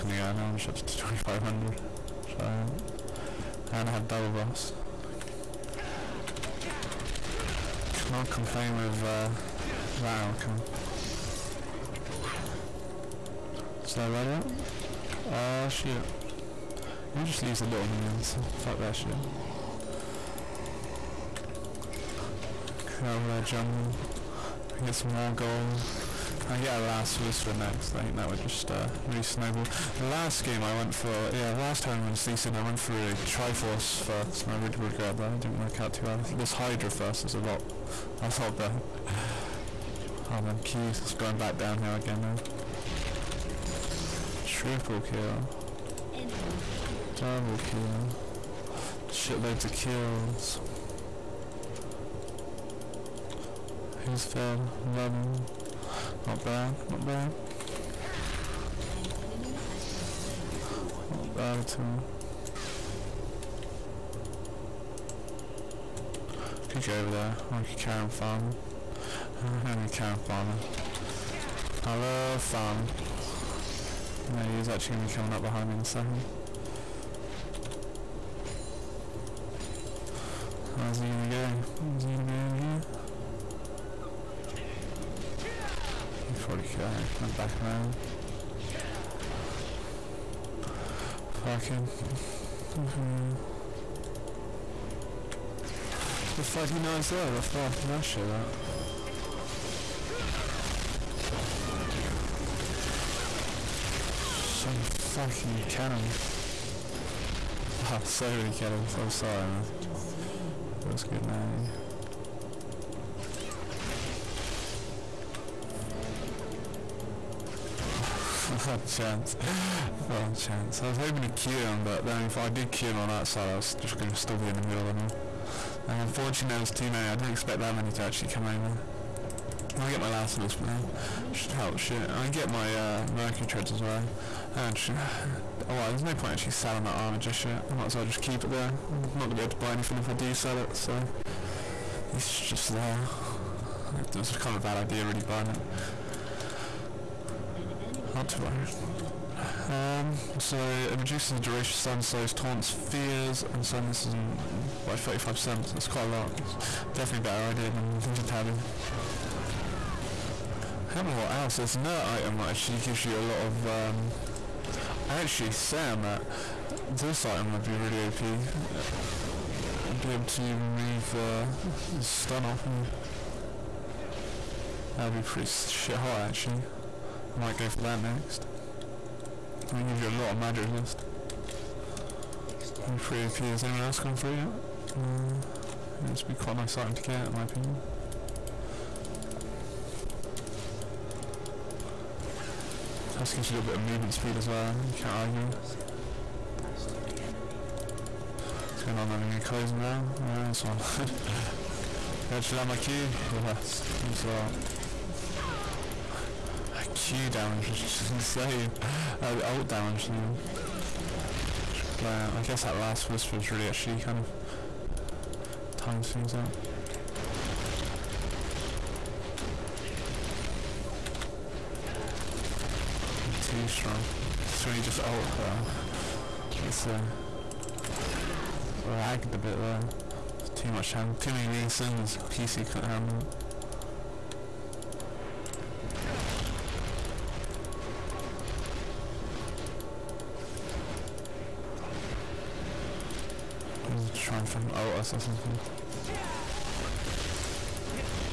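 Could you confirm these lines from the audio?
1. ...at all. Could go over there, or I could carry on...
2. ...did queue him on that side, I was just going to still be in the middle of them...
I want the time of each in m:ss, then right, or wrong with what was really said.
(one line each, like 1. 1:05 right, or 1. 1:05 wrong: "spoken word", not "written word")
1. 1:01 right
2. 2:02 right.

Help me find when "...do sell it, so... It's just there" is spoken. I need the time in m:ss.
2:20.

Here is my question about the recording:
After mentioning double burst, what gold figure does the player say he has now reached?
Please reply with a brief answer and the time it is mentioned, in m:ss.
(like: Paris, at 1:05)
2500, at 0:00.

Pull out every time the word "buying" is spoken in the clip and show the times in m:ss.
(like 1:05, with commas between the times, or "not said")
2:25.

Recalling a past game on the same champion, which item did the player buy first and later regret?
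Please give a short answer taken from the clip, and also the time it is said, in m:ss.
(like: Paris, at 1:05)
Triforce, at 0:33.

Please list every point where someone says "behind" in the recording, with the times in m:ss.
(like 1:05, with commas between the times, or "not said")
1:15.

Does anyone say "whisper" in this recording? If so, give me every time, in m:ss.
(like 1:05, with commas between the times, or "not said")
0:27, 3:33.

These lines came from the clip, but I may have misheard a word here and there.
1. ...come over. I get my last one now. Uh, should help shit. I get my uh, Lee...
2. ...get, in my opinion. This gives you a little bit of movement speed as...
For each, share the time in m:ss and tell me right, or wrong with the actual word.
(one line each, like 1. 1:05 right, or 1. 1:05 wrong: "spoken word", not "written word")
1. 2:08 wrong: "Mercury", not "Lee"
2. 3:07 right.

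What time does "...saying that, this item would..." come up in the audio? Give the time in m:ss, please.
2:45.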